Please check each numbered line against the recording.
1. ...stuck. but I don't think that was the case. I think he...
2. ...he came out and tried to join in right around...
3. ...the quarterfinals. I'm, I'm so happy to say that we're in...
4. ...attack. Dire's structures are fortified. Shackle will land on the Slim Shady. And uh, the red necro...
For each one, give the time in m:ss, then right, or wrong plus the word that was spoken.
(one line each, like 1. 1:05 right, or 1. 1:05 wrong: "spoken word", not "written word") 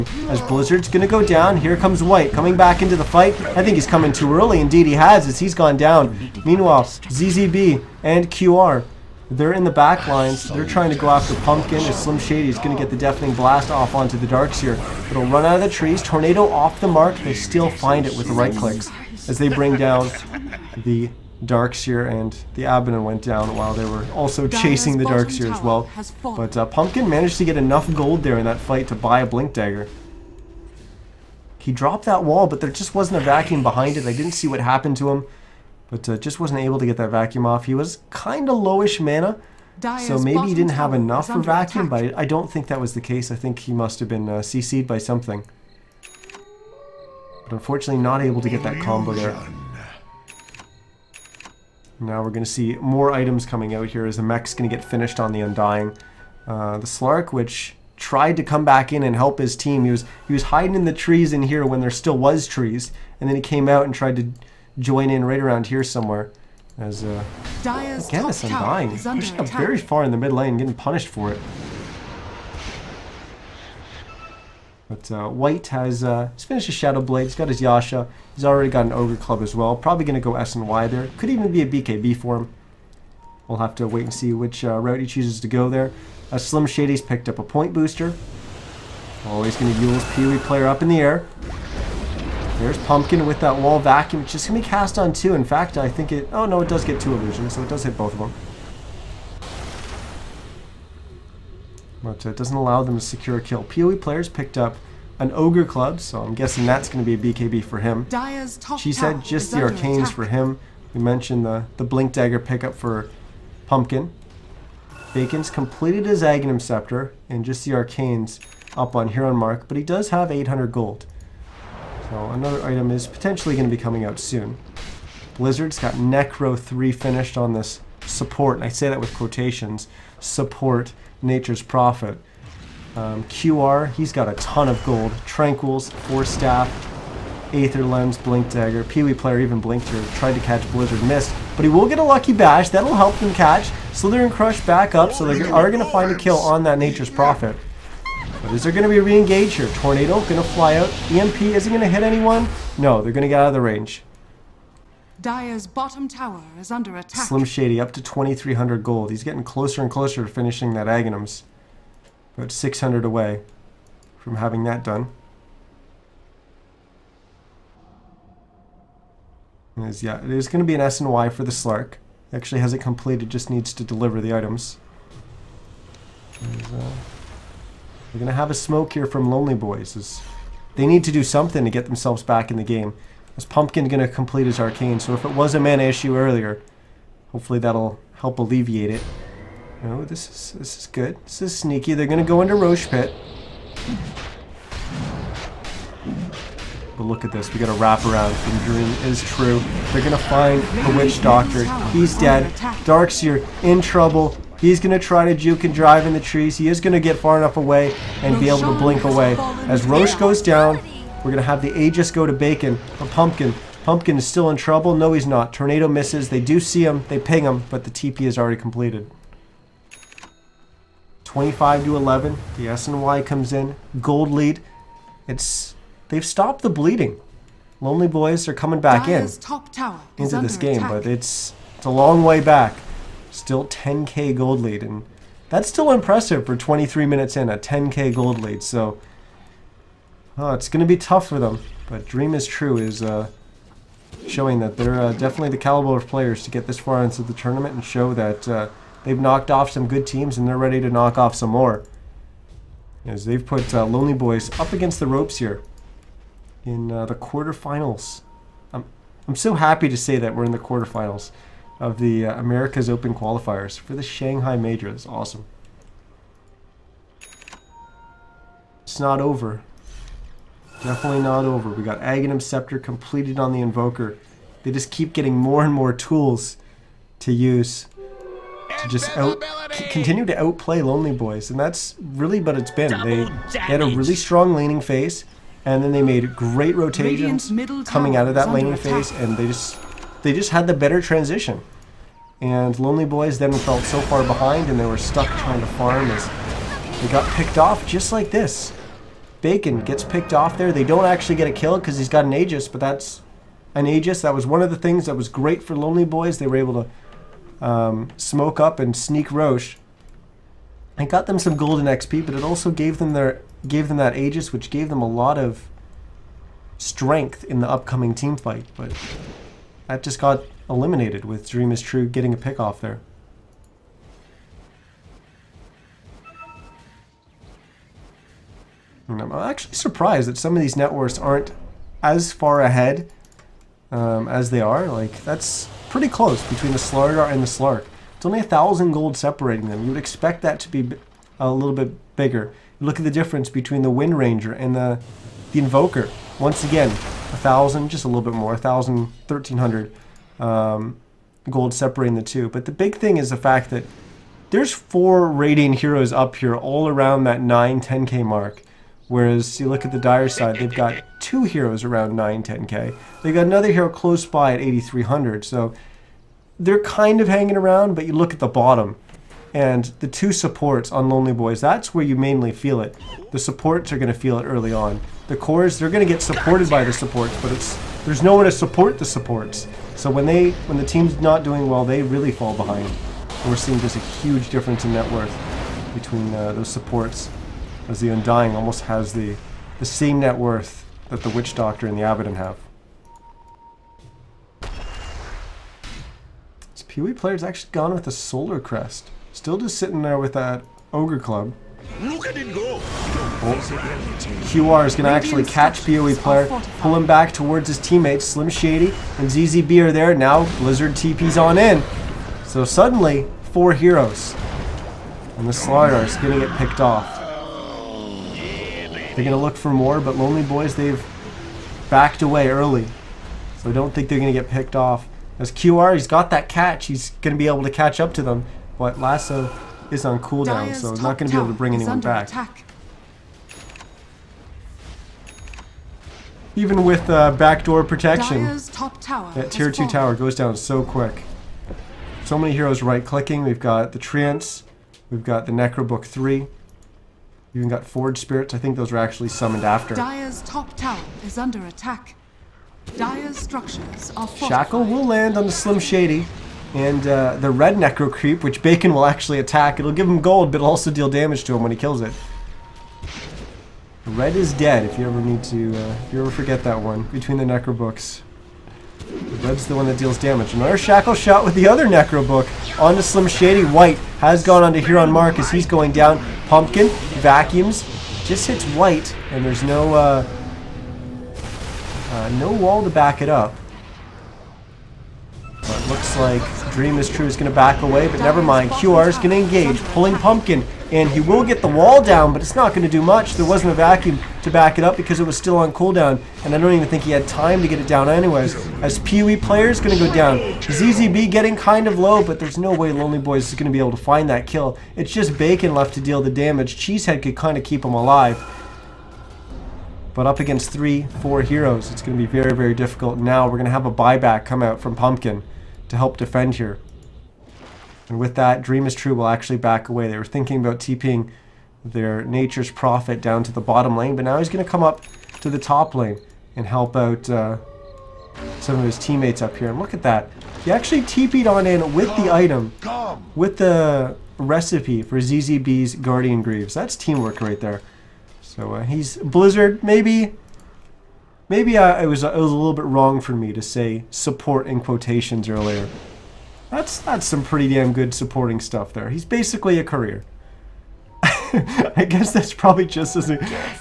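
1. 0:41 wrong: "attack", not "stuck"
2. 1:03 right
3. 4:17 right
4. 7:31 right.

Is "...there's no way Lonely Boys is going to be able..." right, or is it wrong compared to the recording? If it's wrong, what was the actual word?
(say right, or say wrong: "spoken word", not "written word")
right.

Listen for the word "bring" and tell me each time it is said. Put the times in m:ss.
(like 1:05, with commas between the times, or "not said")
0:19, 7:11.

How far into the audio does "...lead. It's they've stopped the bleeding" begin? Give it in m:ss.
3:44.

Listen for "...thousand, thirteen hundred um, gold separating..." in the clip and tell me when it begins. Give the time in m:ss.
5:48.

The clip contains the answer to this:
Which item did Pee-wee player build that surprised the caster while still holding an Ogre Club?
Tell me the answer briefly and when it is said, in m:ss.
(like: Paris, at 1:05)
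Solar Crest, at 6:38.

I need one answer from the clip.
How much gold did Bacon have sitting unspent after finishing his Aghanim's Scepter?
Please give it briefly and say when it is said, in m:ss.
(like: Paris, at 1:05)
800, at 2:00.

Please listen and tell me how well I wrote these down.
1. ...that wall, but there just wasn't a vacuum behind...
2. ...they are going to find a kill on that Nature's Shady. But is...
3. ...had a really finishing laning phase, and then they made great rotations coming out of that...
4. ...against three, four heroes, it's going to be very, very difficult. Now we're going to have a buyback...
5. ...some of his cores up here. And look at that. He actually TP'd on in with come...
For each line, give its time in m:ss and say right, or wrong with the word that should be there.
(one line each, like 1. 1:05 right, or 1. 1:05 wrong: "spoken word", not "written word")
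1. 0:32 right
2. 2:25 wrong: "Prophet", not "Shady"
3. 4:43 wrong: "strong", not "finishing"
4. 8:30 right
5. 8:48 wrong: "teammates", not "cores".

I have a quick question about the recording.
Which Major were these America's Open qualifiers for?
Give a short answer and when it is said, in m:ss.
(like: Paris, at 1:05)
Shanghai Major, at 4:24.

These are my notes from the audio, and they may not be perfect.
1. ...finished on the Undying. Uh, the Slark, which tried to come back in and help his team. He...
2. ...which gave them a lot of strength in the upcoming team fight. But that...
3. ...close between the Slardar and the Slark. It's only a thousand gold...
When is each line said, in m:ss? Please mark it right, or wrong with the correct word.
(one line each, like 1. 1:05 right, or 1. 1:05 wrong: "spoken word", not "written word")
1. 0:54 right
2. 5:14 right
3. 5:36 right.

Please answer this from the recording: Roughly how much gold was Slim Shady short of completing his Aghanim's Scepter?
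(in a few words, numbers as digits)
600.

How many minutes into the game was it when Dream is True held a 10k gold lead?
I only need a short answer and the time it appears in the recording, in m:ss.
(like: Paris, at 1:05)
23, at 3:56.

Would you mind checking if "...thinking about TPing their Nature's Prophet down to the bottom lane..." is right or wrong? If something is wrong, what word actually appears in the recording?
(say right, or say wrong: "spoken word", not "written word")
right.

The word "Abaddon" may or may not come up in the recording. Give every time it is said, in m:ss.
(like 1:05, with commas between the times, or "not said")
0:22, 6:32.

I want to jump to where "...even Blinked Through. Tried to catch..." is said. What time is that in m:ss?
2:19.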